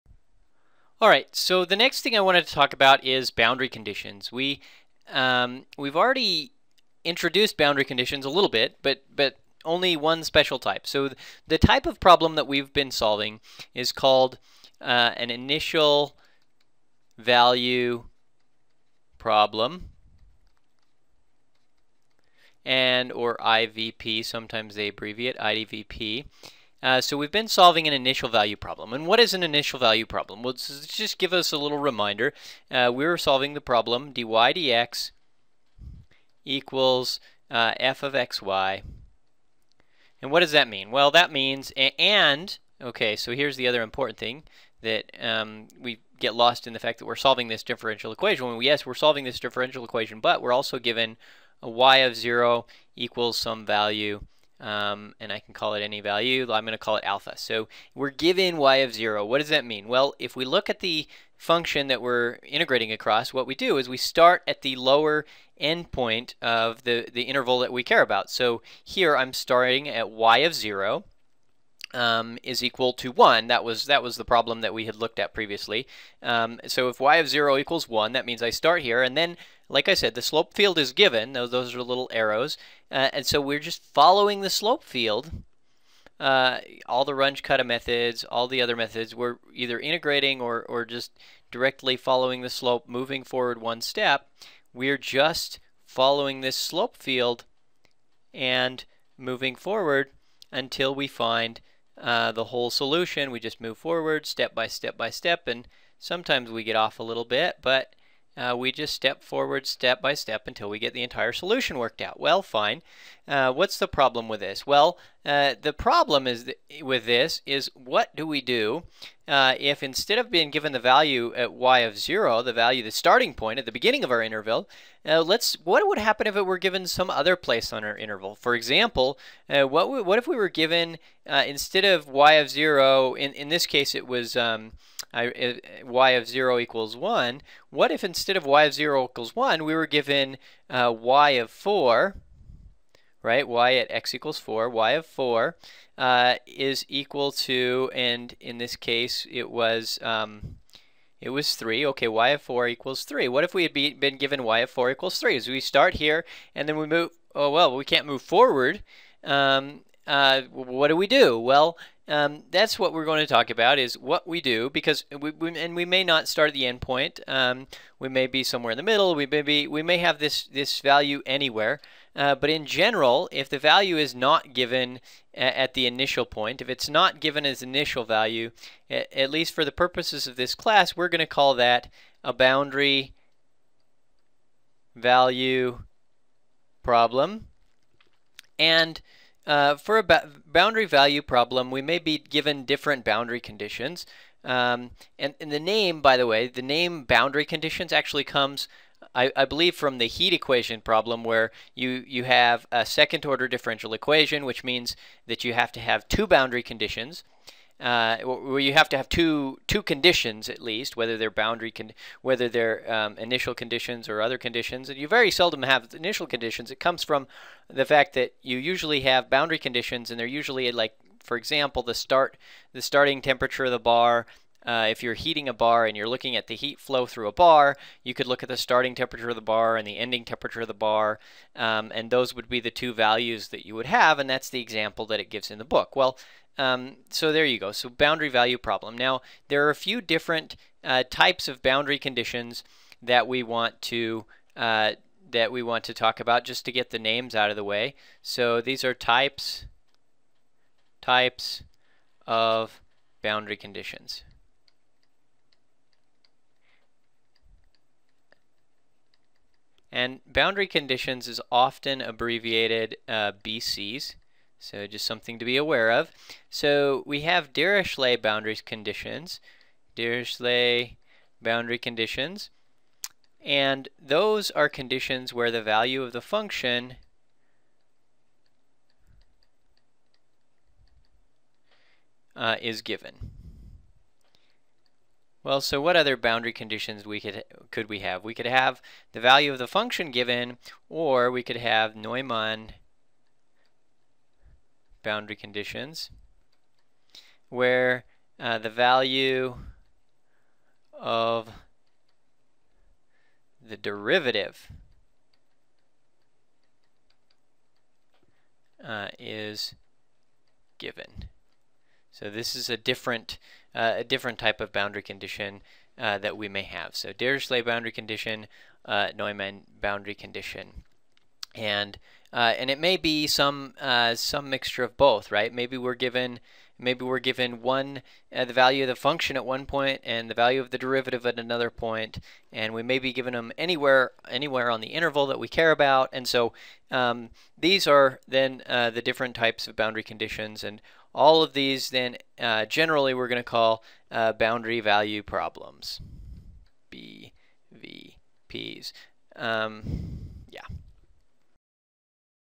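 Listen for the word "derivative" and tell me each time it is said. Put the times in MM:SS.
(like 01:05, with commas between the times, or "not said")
05:03, 05:30.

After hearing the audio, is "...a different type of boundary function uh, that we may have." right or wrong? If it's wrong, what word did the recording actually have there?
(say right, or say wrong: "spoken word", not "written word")
wrong: "condition", not "function".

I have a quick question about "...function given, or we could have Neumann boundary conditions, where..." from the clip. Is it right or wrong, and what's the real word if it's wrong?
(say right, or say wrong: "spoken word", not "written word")
right.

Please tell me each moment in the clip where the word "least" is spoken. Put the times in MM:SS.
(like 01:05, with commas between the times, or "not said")
02:59, 03:30.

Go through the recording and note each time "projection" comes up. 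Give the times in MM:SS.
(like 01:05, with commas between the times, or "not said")
not said.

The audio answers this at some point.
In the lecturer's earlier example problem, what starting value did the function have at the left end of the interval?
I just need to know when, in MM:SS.
01:12.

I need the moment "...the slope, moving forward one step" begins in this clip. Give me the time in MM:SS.
01:32.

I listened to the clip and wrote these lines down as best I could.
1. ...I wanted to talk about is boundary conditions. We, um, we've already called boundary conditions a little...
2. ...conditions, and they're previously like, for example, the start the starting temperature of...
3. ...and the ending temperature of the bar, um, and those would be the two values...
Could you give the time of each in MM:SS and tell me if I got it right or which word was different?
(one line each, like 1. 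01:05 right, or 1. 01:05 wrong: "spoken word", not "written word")
1. 00:02 wrong: "introduced", not "called"
2. 03:39 wrong: "usually", not "previously"
3. 03:49 right.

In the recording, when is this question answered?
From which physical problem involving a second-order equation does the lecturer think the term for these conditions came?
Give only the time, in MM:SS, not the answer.
03:20.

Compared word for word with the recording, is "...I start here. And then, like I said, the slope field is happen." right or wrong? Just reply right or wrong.
wrong.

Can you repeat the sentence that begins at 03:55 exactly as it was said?
Well, um, so there you go.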